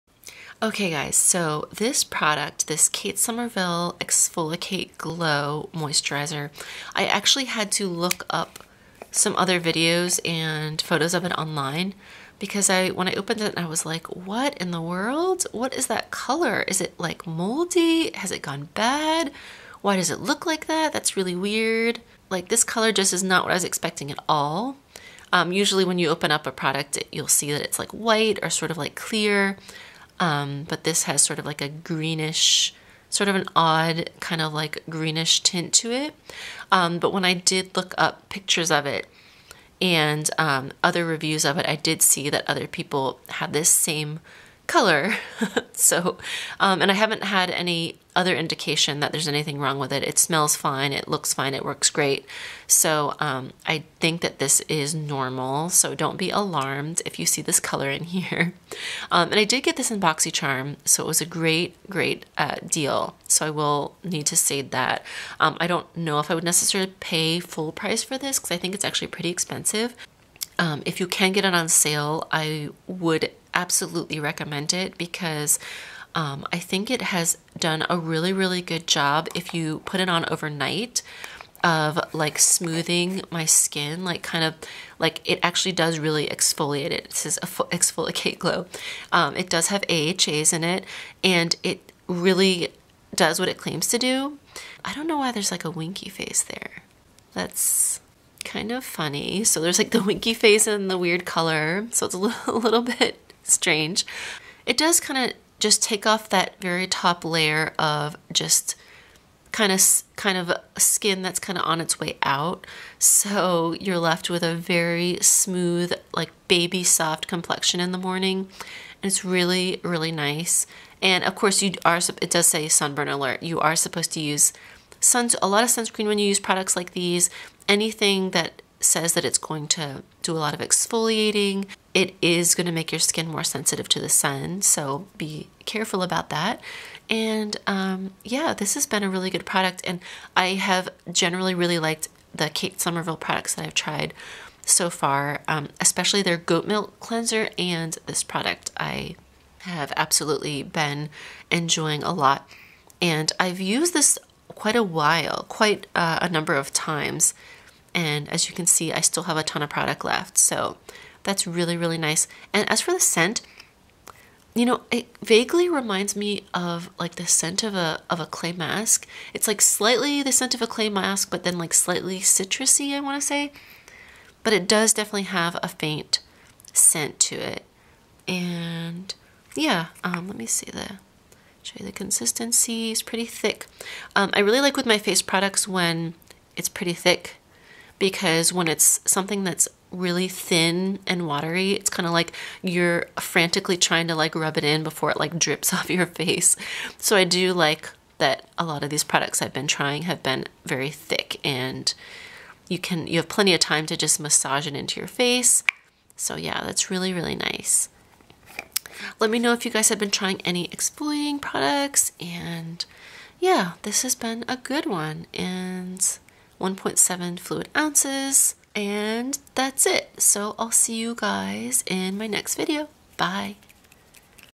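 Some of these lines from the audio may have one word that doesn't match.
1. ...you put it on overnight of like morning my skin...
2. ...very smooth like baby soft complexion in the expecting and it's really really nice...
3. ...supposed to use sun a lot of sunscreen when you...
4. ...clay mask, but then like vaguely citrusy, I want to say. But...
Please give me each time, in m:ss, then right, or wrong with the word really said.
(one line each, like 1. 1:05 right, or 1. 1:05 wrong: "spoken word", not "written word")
1. 1:19 wrong: "smoothing", not "morning"
2. 1:54 wrong: "morning", not "expecting"
3. 2:03 right
4. 2:50 wrong: "slightly", not "vaguely".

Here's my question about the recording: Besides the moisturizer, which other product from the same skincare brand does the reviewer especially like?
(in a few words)
goat milk cleanser.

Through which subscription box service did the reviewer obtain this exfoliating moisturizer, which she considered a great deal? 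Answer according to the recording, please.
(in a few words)
BoxyCharm.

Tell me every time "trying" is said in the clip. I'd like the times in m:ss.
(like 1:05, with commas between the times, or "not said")
3:13, 3:19, 3:30.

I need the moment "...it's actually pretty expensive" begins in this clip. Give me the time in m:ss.
1:08.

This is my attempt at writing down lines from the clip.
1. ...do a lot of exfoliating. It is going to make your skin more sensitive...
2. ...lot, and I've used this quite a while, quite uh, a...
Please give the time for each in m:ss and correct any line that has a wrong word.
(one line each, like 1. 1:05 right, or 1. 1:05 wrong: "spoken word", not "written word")
1. 2:10 right
2. 2:32 right.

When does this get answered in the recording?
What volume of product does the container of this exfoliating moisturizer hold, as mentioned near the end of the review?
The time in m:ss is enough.
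3:36.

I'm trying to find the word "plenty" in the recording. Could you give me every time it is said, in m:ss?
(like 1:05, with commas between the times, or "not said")
3:23.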